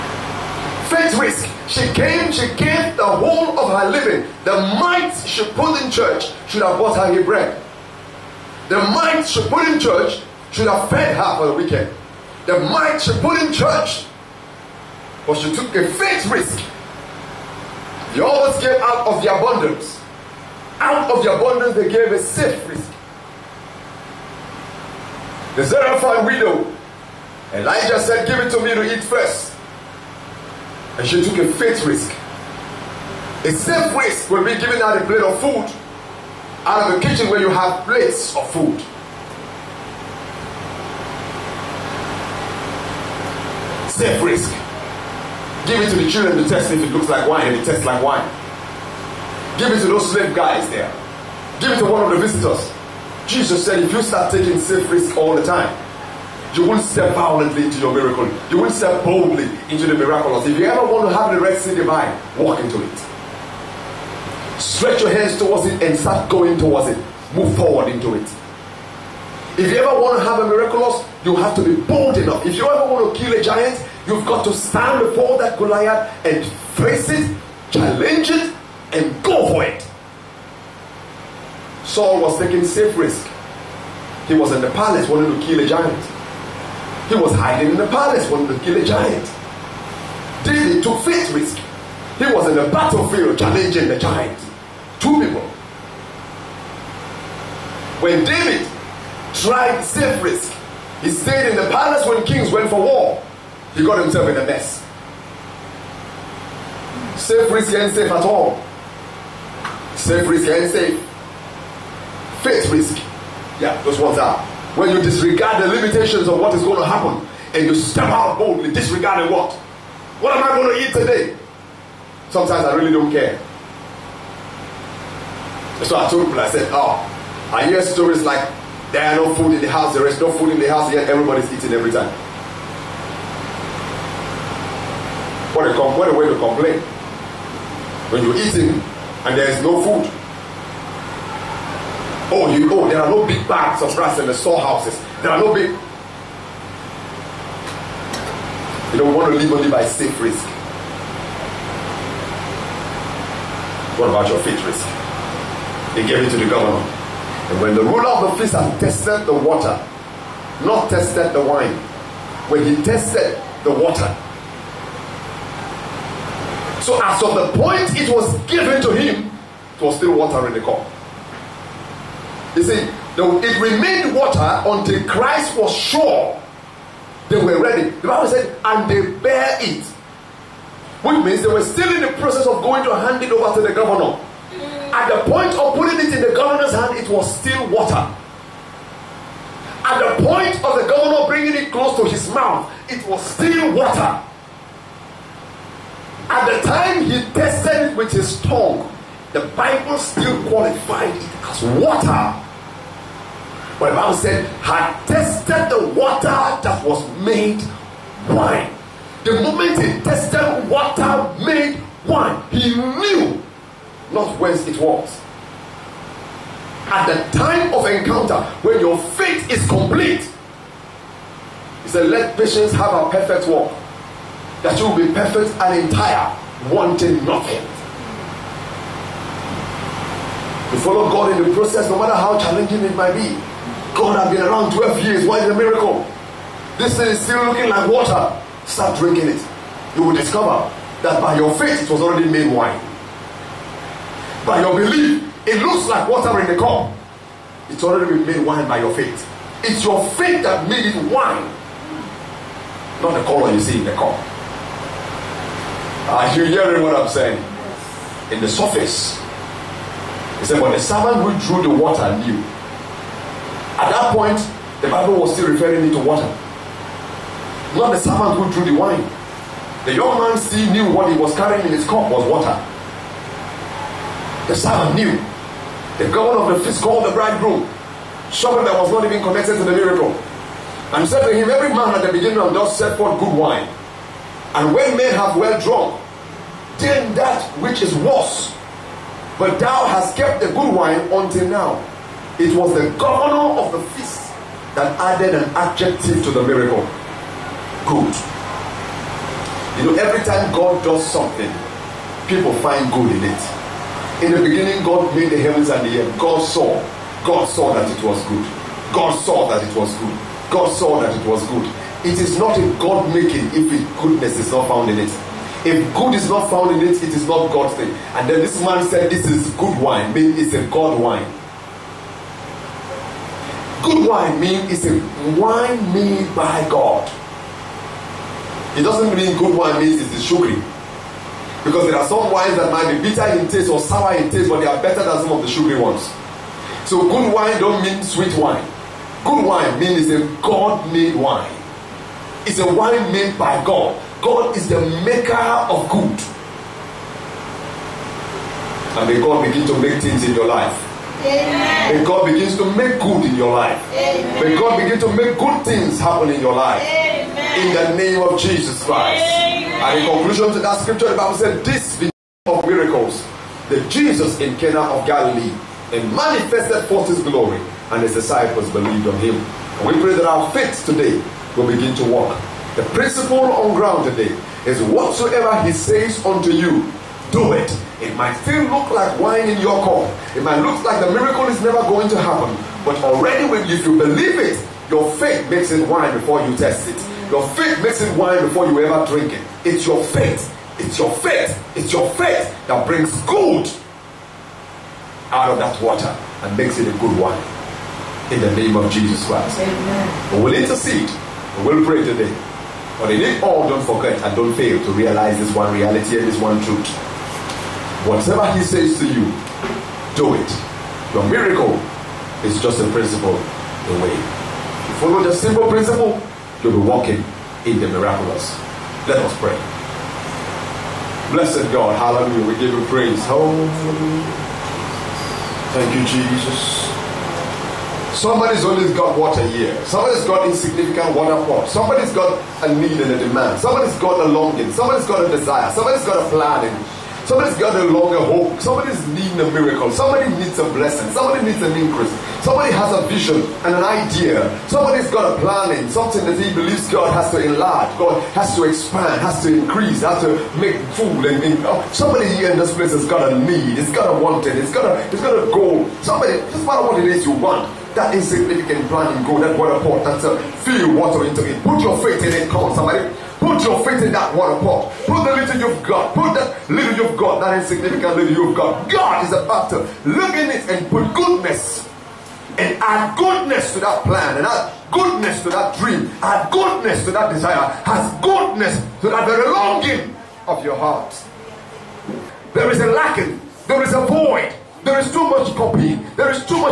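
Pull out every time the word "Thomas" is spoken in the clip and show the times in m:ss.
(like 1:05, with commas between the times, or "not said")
not said.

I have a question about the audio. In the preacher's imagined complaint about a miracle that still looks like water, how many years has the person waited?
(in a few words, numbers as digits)
12.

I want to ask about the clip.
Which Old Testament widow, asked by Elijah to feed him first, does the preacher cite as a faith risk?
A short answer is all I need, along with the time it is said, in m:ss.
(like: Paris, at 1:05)
Zarephath widow, at 0:25.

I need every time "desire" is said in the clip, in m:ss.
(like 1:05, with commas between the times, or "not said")
7:15, 7:57.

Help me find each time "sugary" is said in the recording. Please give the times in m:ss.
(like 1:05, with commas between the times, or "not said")
5:30, 5:35.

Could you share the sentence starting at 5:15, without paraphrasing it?
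If good is not found in it, it is not God's thing.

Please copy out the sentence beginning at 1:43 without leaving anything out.
He got himself in a mess.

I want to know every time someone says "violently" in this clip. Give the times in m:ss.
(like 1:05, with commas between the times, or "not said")
0:57.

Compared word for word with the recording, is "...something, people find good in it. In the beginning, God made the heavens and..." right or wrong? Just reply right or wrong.
right.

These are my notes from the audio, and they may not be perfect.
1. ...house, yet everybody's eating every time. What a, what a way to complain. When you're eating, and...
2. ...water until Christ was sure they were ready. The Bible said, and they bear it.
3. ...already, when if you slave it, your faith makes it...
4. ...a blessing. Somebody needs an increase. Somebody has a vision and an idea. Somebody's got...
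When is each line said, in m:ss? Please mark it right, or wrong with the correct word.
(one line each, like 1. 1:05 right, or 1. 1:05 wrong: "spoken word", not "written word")
1. 2:10 right
2. 2:54 right
3. 6:23 wrong: "believe", not "slave"
4. 7:20 right.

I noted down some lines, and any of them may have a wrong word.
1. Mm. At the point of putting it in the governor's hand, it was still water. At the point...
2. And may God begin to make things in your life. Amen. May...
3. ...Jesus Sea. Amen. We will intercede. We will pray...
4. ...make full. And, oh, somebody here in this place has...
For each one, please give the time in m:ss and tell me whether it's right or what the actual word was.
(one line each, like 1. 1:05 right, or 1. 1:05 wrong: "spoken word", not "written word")
1. 3:04 right
2. 5:48 right
3. 6:38 wrong: "Christ", not "Sea"
4. 7:30 right.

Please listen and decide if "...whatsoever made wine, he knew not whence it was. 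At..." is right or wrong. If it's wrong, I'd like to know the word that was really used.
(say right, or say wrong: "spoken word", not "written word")
wrong: "water", not "whatsoever".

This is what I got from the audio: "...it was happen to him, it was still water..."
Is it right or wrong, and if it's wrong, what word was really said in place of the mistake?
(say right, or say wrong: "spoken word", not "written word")
wrong: "given", not "happen".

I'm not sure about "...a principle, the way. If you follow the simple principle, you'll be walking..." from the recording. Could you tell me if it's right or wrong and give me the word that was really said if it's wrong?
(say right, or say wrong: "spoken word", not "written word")
right.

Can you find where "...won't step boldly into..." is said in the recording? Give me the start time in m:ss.
0:58.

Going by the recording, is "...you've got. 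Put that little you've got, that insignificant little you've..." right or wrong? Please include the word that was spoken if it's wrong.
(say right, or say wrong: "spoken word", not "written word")
right.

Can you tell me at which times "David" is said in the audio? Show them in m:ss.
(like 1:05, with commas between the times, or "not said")
1:30, 1:38.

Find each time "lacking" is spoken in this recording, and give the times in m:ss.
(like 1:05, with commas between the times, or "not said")
8:02.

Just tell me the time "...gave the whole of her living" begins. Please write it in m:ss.
0:02.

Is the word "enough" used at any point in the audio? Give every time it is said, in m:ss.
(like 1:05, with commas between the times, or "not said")
1:12.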